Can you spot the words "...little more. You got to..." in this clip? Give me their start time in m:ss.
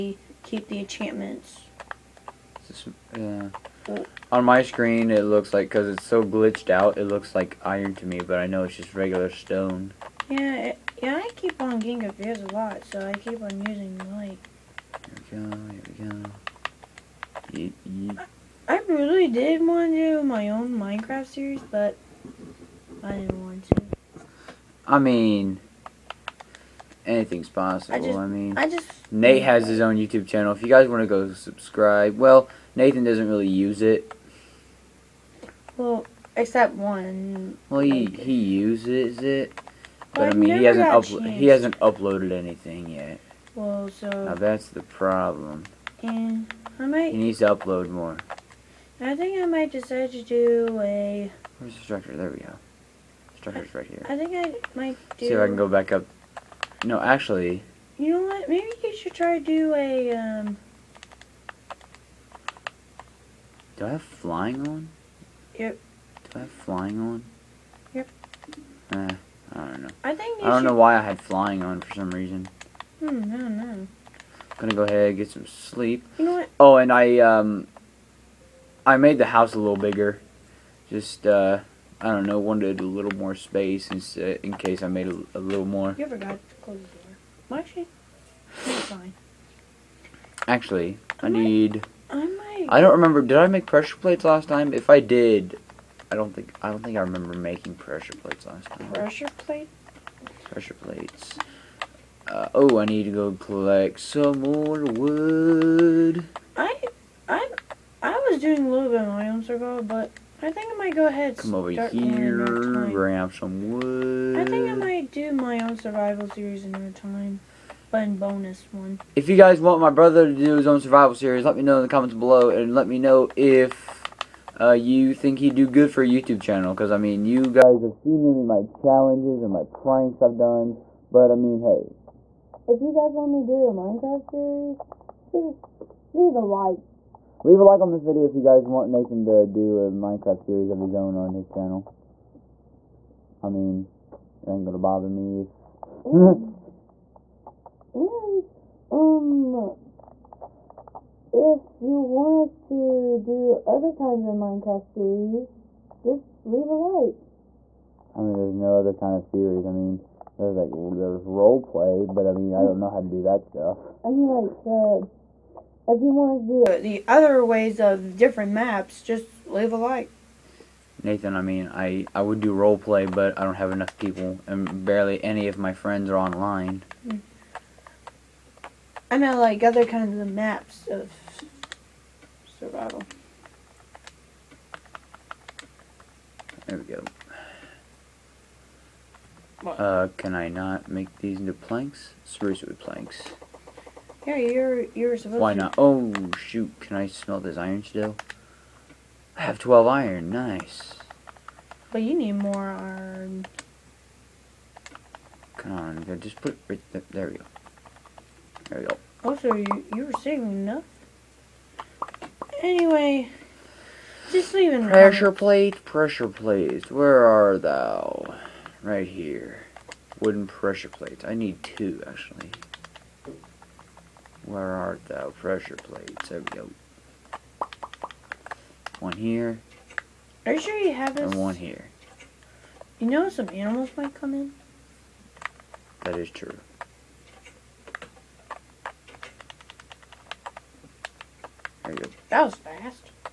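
1:25.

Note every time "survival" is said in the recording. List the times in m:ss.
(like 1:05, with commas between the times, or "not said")
1:55, 2:00, 3:02.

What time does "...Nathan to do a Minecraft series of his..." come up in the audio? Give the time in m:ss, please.
2:18.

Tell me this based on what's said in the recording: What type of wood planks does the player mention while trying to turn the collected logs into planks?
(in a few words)
Spruce.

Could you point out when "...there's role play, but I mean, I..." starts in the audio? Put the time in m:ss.
2:40.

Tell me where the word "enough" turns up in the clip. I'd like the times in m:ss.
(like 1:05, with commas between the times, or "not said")
2:53, 3:30.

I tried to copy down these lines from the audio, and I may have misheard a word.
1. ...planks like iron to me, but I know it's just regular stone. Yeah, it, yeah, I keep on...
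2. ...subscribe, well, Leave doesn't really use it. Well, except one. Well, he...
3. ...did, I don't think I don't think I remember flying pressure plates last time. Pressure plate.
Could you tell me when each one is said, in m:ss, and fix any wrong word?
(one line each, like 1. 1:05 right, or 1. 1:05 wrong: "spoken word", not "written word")
1. 0:07 wrong: "looks", not "planks"
2. 0:31 wrong: "Nathan", not "Leave"
3. 1:35 wrong: "making", not "flying".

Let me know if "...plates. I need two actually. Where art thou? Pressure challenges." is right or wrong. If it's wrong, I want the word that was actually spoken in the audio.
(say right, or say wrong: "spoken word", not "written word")
wrong: "plates", not "challenges".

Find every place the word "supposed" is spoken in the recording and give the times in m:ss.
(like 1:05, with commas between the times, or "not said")
3:15.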